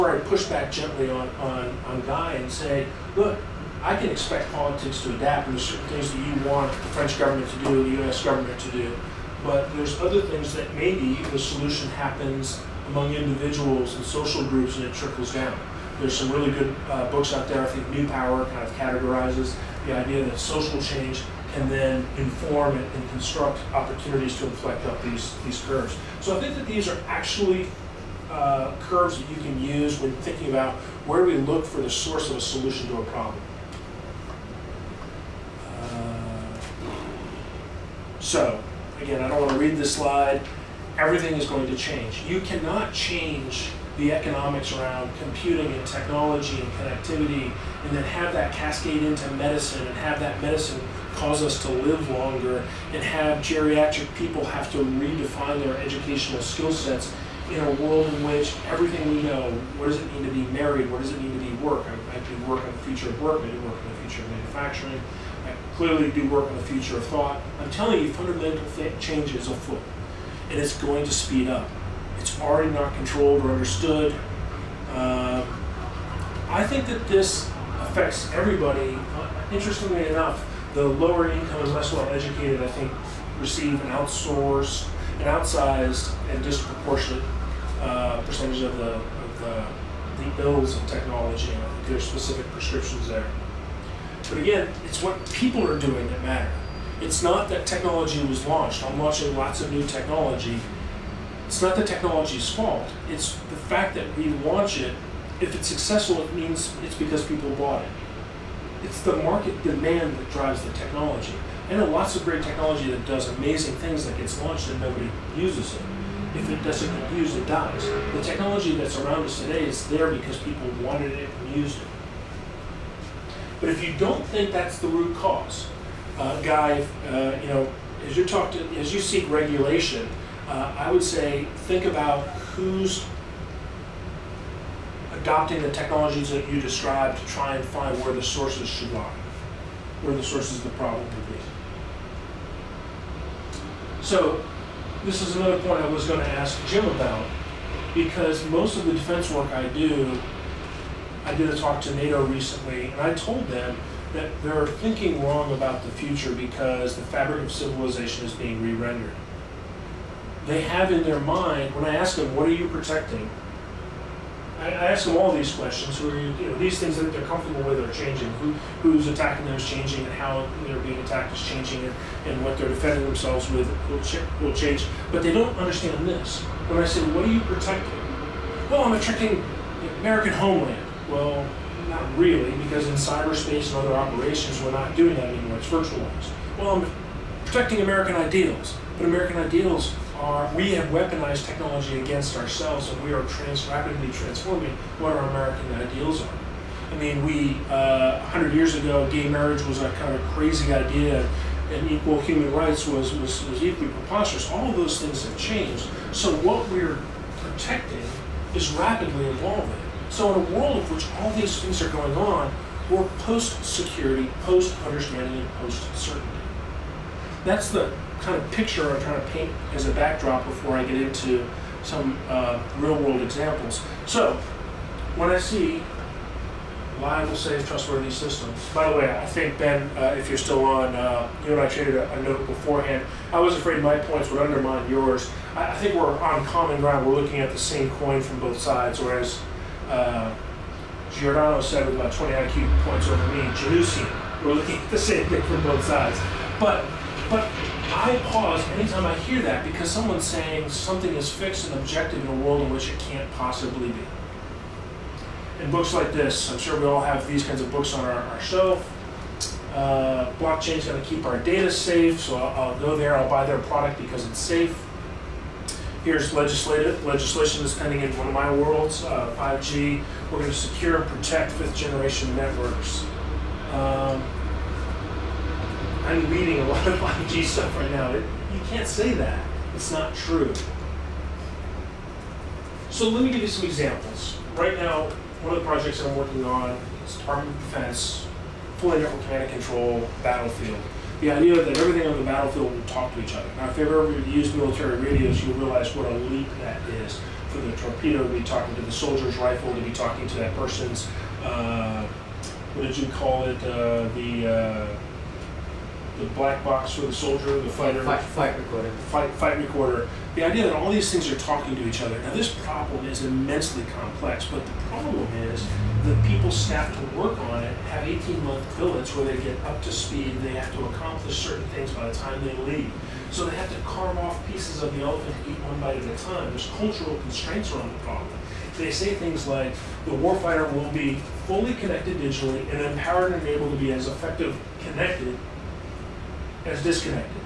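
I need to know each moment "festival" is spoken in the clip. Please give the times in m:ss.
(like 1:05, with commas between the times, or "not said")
not said.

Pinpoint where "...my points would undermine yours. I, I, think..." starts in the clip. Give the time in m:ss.
3:53.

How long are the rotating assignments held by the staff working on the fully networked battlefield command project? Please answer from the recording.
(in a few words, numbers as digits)
18 months.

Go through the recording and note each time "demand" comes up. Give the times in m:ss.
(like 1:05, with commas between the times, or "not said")
1:49.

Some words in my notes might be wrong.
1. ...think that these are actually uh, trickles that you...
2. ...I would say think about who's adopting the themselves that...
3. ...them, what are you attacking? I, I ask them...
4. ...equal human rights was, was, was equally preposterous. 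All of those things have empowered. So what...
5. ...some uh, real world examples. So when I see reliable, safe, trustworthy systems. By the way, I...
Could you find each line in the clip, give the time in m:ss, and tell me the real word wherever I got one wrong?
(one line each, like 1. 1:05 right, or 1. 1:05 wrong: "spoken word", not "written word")
1. 0:26 wrong: "curves", not "trickles"
2. 2:10 wrong: "technologies", not "themselves"
3. 2:42 wrong: "protecting", not "attacking"
4. 3:21 wrong: "changed", not "empowered"
5. 3:41 right.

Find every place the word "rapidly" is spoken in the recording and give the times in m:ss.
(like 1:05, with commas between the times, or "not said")
3:13, 3:28.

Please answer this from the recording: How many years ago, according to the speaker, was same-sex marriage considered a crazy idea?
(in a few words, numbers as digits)
100.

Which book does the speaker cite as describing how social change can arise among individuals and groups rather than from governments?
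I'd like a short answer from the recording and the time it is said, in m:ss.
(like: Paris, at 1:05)
New Power, at 0:17.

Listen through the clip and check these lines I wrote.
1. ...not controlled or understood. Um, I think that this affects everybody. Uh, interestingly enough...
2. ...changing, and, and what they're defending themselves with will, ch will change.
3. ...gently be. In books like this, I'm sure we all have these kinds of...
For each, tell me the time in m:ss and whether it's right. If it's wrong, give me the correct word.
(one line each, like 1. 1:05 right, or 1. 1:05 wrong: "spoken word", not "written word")
1. 1:12 right
2. 2:51 right
3. 4:13 wrong: "possibly", not "gently".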